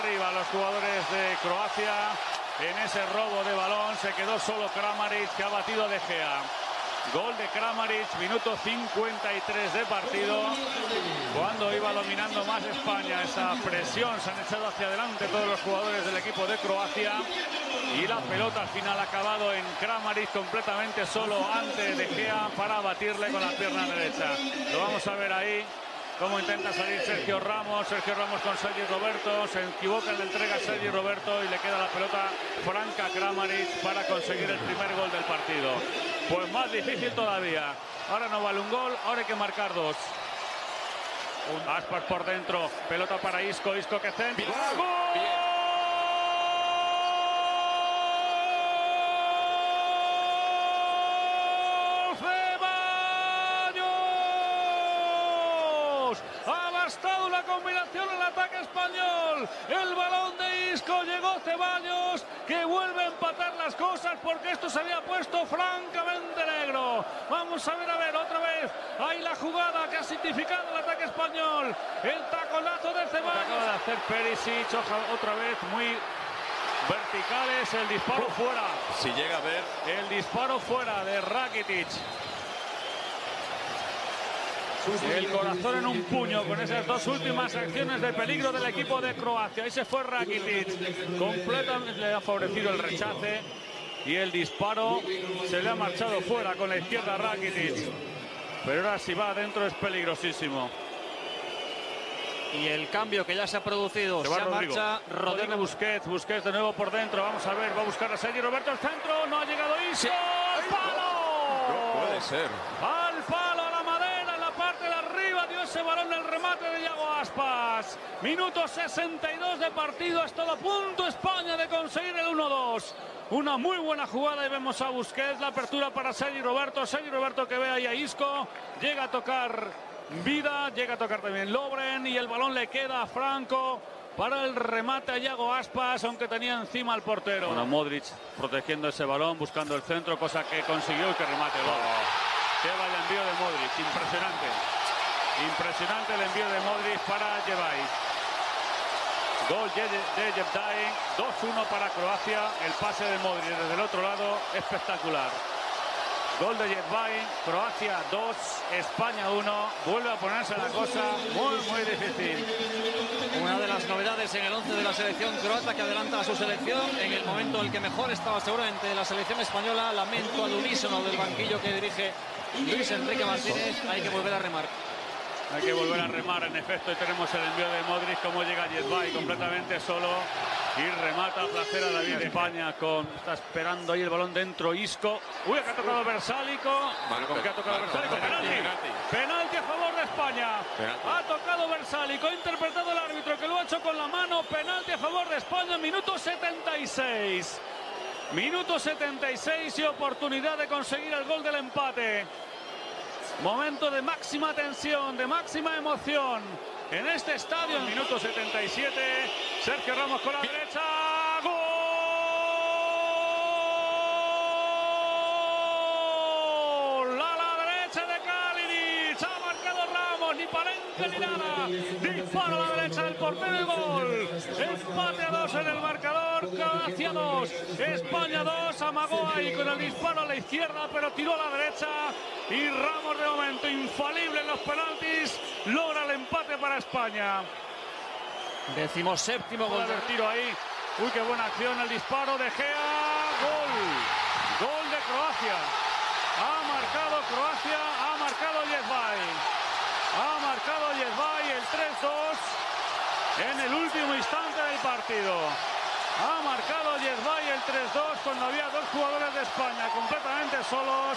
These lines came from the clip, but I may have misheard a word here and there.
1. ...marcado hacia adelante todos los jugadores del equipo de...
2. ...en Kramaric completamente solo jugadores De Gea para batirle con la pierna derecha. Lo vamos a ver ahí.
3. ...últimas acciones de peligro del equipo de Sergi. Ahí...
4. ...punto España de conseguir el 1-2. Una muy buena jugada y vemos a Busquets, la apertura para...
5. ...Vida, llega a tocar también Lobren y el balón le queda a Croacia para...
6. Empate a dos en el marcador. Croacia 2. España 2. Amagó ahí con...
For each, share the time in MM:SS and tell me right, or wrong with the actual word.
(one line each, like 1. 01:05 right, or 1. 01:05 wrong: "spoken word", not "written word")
1. 00:14 wrong: "echado", not "marcado"
2. 00:19 wrong: "antes", not "jugadores"
3. 01:27 wrong: "Croacia", not "Sergi"
4. 02:00 right
5. 02:10 wrong: "Franco", not "Croacia"
6. 03:44 right.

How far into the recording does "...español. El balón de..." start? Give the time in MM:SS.
00:58.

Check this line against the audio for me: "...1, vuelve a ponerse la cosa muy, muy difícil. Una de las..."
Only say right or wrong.
right.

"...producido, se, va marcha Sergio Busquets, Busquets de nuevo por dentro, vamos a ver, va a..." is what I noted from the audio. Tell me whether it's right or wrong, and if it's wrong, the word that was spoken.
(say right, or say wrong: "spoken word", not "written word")
wrong: "Rodrigo", not "Sergio".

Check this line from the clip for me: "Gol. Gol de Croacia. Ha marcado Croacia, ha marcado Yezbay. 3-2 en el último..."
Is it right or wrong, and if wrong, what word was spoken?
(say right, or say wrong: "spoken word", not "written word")
right.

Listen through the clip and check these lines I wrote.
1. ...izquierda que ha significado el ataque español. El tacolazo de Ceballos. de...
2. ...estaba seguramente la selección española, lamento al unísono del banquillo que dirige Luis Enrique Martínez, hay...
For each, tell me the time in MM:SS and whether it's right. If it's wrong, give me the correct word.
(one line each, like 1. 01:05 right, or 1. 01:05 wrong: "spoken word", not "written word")
1. 01:09 wrong: "jugada", not "izquierda"
2. 02:48 right.